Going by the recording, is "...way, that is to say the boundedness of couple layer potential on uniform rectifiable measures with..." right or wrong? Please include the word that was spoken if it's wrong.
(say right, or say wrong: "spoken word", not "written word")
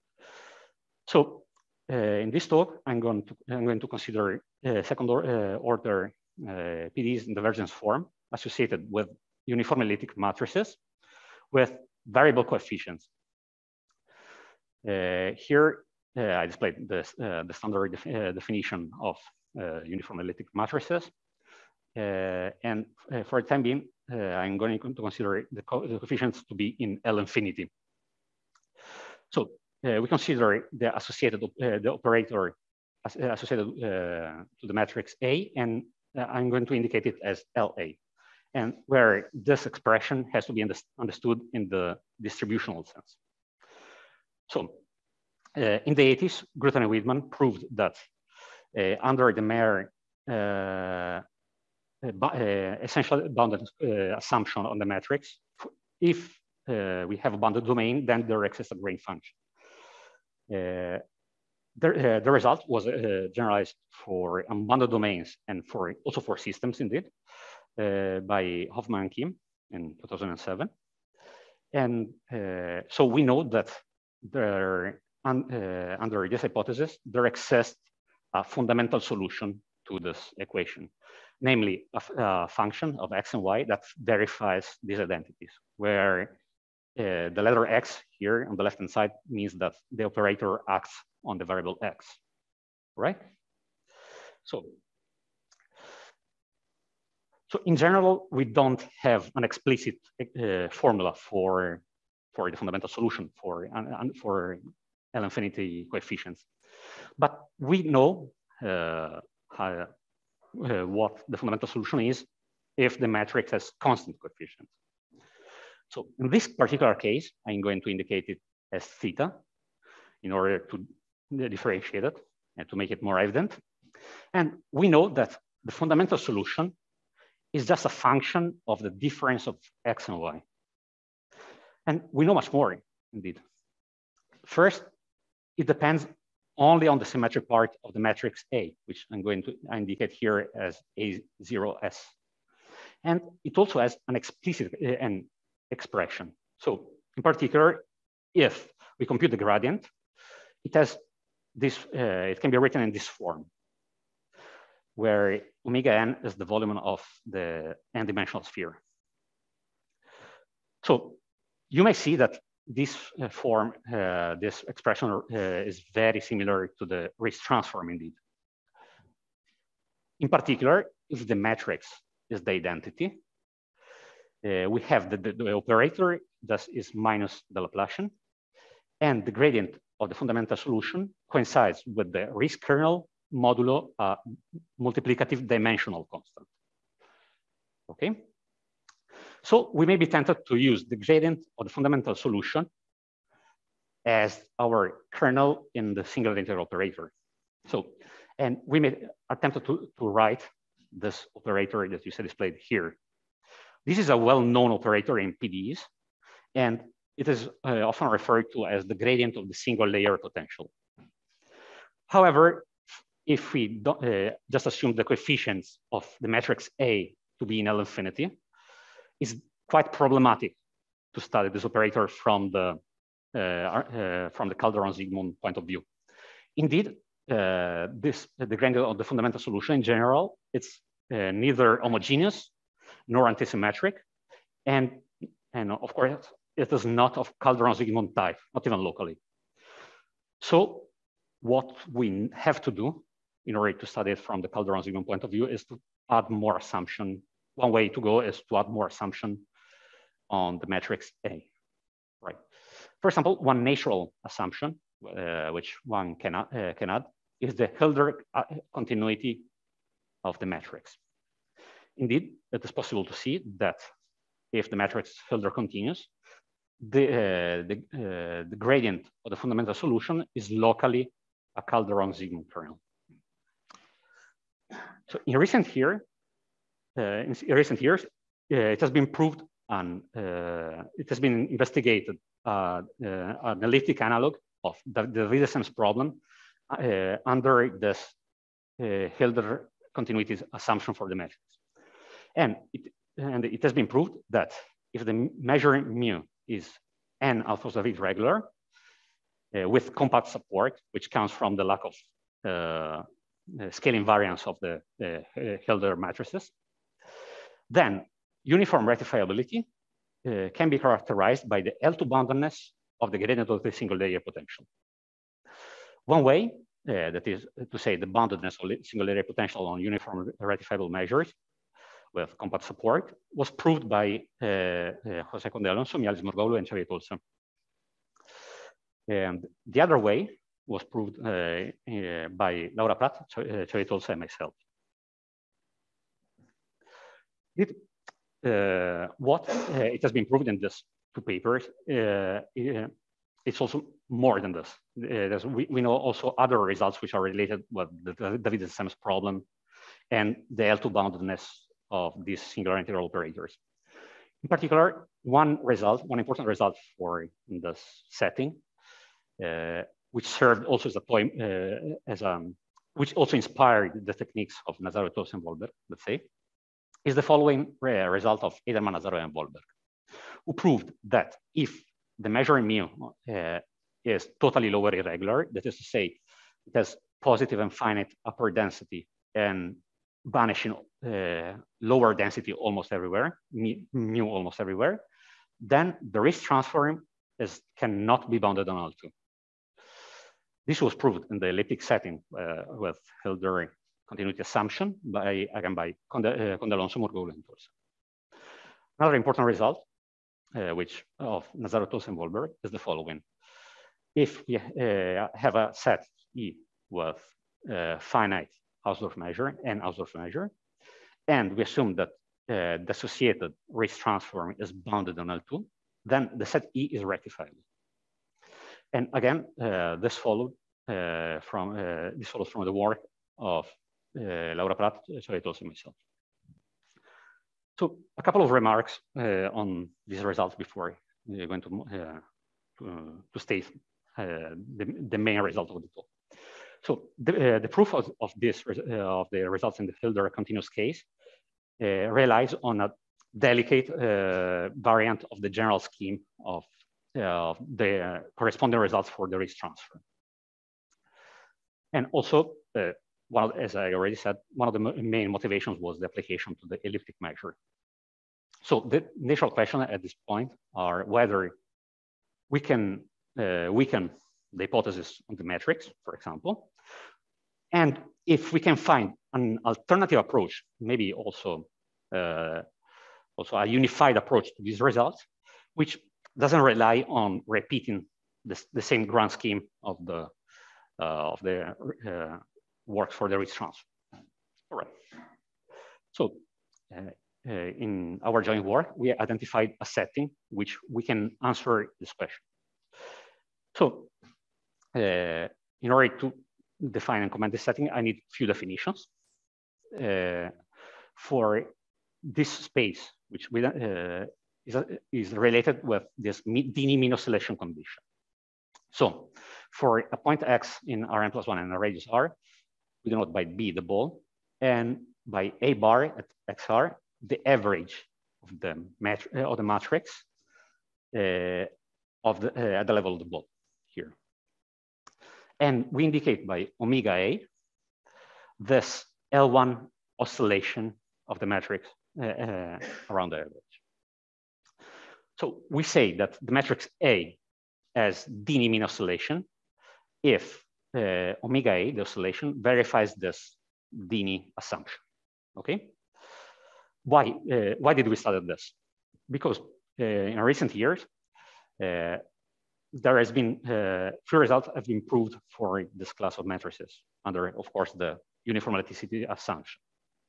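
wrong: "single", not "couple".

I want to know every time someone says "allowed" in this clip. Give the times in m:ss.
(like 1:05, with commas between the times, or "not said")
not said.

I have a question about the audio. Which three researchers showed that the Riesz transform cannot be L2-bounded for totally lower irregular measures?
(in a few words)
Eiderman, Nazarov, and Volberg.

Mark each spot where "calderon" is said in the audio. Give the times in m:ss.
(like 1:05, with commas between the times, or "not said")
3:44, 3:57, 4:04, 4:31.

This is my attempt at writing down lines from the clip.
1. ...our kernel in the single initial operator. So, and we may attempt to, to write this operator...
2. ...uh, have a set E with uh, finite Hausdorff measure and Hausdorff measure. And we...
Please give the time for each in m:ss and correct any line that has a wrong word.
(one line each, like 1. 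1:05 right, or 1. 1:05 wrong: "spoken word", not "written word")
1. 3:14 wrong: "integral", not "initial"
2. 6:44 right.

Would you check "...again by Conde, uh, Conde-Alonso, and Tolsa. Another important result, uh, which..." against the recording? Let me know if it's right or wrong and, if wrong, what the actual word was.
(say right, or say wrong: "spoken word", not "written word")
right.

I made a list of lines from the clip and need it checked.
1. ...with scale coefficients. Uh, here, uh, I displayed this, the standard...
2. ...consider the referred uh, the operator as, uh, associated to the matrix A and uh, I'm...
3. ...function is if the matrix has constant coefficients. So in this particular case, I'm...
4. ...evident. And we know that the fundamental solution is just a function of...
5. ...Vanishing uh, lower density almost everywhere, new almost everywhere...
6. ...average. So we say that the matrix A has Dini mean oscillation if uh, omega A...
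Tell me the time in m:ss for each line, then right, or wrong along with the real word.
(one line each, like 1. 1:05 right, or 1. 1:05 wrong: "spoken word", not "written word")
1. 0:11 wrong: "variable", not "scale"
2. 0:30 wrong: "associated", not "referred"
3. 1:51 wrong: "solution", not "function"
4. 2:03 right
5. 6:20 right
6. 8:53 right.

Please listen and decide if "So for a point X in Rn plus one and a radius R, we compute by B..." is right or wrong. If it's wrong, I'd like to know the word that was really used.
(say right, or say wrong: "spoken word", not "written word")
wrong: "denote", not "compute".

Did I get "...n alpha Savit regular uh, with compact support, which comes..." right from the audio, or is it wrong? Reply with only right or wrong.
right.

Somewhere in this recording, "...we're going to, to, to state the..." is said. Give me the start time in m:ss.
7:11.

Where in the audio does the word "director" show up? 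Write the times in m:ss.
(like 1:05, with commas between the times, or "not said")
not said.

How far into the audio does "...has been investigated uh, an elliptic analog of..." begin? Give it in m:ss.
4:41.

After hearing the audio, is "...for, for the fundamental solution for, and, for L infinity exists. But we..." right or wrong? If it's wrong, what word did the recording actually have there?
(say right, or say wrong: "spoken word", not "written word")
wrong: "coefficients", not "exists".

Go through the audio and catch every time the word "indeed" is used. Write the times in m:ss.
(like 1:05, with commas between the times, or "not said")
1:06, 2:13, 2:47, 3:46, 4:21.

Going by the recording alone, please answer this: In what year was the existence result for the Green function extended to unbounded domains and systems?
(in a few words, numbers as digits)
2007.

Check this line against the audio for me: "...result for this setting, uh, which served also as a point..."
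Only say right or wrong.
right.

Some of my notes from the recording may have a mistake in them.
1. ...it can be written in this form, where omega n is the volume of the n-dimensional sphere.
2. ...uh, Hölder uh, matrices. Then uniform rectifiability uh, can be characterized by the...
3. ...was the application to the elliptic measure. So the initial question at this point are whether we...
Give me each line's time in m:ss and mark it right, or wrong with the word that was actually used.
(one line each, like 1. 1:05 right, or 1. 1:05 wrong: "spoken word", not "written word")
1. 2:32 right
2. 5:05 right
3. 7:35 right.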